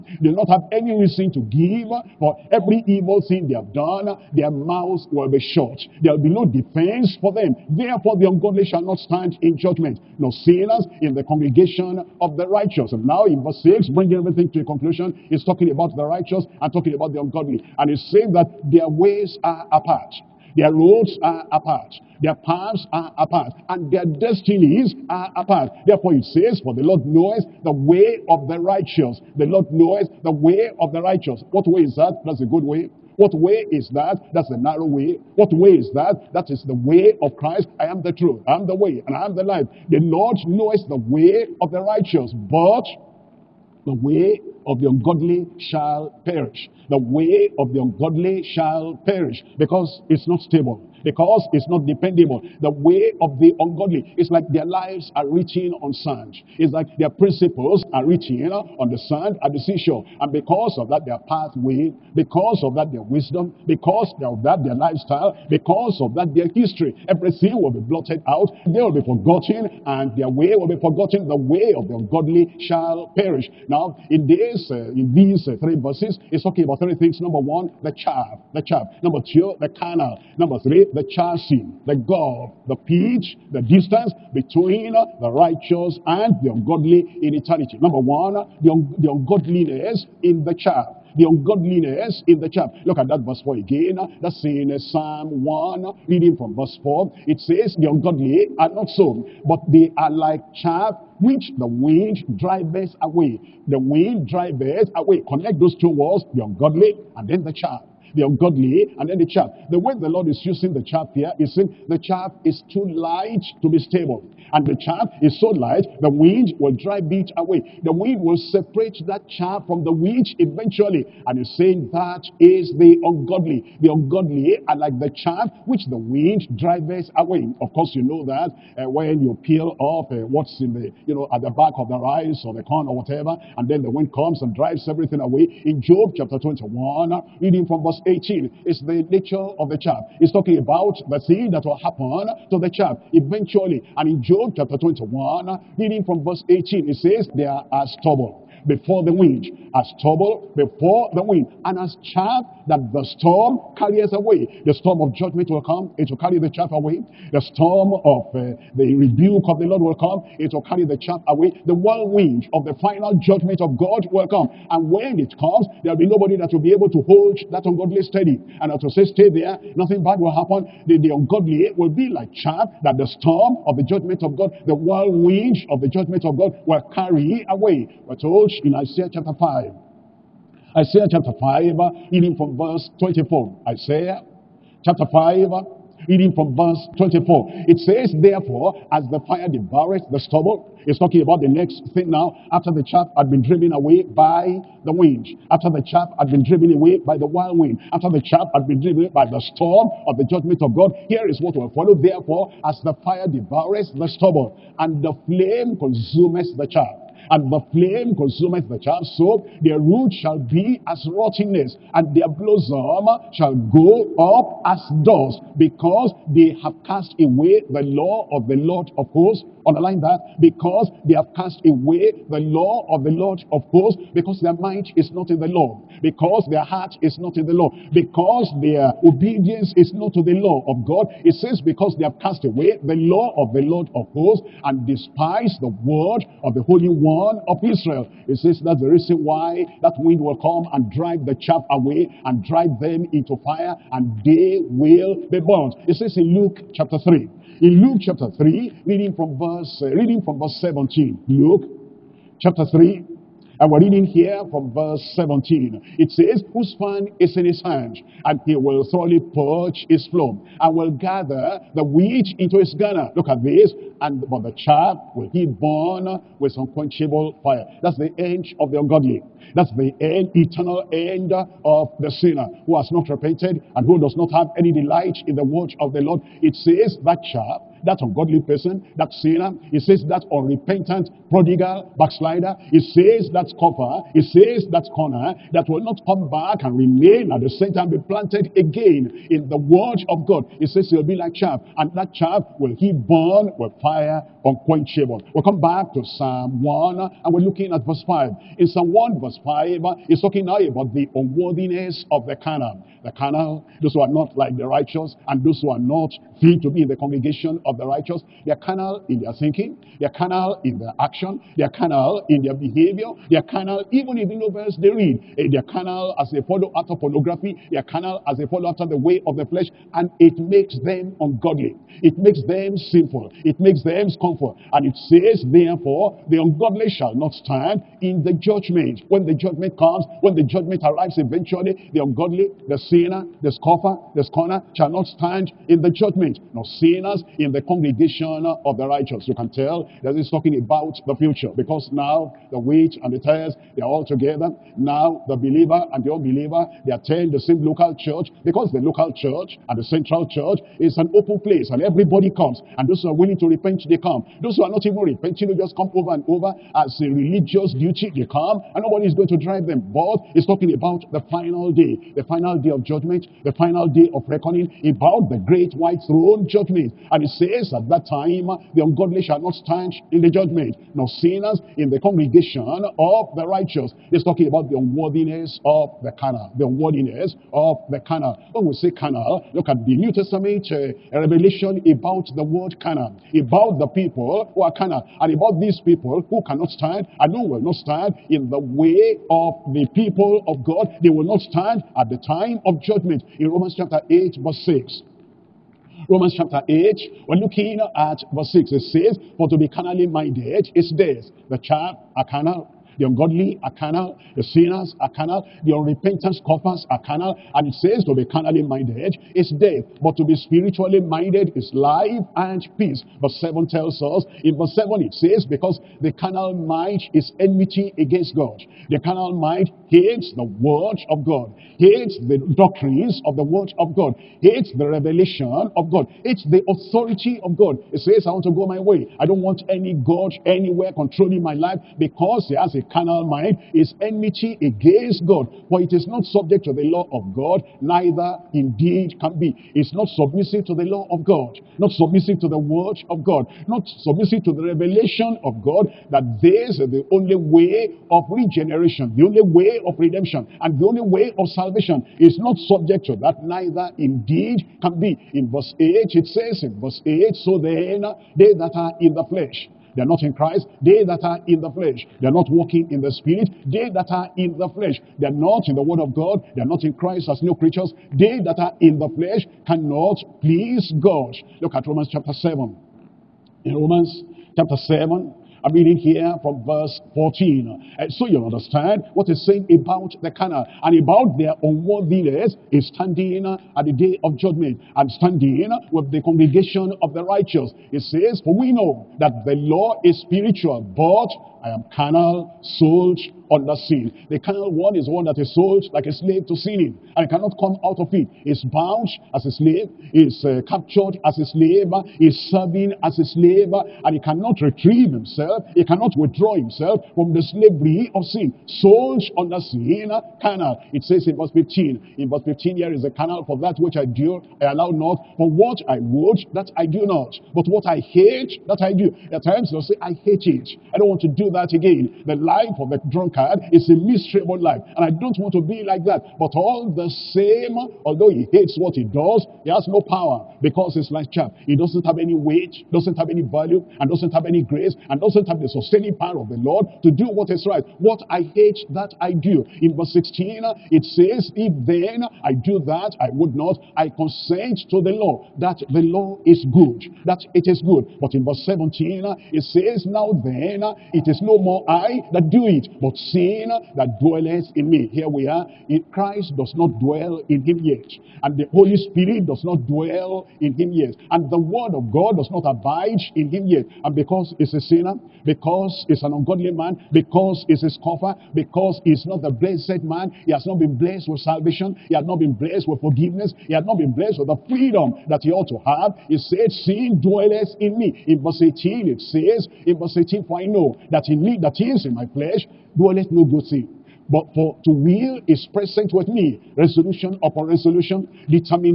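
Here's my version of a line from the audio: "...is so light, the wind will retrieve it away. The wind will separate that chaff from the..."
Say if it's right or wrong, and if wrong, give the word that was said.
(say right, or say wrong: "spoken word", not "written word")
wrong: "drive", not "retrieve".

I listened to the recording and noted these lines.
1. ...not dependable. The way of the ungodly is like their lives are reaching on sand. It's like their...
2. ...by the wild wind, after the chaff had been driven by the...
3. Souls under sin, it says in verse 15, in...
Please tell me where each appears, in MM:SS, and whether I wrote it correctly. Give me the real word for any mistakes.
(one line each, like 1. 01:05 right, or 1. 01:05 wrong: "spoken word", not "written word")
1. 00:51 right
2. 03:16 right
3. 08:28 right.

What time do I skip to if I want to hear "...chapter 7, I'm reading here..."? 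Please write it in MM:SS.
07:54.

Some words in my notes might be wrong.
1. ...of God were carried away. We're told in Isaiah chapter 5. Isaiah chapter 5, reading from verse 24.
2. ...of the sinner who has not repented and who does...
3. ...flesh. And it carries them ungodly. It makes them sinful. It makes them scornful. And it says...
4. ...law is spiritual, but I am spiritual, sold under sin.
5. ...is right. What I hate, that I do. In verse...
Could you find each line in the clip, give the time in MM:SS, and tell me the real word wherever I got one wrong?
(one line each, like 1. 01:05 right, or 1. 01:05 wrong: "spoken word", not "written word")
1. 02:56 right
2. 04:31 right
3. 05:19 wrong: "makes", not "carries"
4. 08:09 wrong: "carnal", not "spiritual"
5. 08:57 right.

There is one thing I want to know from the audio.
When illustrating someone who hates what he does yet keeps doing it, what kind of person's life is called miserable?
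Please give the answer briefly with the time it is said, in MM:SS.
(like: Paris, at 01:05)
The drunkard, at 08:42.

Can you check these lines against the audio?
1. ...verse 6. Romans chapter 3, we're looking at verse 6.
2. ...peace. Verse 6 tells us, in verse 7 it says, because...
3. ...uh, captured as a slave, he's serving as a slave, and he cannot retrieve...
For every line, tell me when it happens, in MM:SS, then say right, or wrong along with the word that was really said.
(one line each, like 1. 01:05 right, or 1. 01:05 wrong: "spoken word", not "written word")
1. 06:34 wrong: "8", not "3"
2. 06:52 wrong: "7", not "6"
3. 08:20 right.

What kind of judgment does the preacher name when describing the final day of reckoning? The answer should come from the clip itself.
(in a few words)
Great white throne judgment.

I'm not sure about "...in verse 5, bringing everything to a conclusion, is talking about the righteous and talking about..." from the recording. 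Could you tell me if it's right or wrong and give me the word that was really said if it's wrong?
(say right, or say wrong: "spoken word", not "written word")
wrong: "6", not "5".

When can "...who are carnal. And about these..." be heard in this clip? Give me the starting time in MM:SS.
06:24.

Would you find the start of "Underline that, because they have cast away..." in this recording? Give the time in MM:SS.
03:39.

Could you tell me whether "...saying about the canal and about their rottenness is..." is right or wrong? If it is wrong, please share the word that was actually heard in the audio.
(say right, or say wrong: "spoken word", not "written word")
wrong: "unworthiness", not "rottenness".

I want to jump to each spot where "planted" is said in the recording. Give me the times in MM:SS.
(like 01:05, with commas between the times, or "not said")
04:48.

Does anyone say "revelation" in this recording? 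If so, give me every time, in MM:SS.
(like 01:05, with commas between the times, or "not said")
06:21, 07:04, 07:24.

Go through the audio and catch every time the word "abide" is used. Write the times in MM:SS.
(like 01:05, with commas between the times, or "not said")
09:22.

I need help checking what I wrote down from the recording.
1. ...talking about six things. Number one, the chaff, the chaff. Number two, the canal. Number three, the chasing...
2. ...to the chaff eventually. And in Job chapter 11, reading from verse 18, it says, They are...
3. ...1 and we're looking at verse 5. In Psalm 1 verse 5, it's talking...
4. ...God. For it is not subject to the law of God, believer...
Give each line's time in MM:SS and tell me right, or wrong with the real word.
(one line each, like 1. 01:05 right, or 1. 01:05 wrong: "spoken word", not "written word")
1. 01:16 wrong: "three", not "six"
2. 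02:22 wrong: "21", not "11"
3. 04:56 right
4. 07:15 wrong: "neither", not "believer".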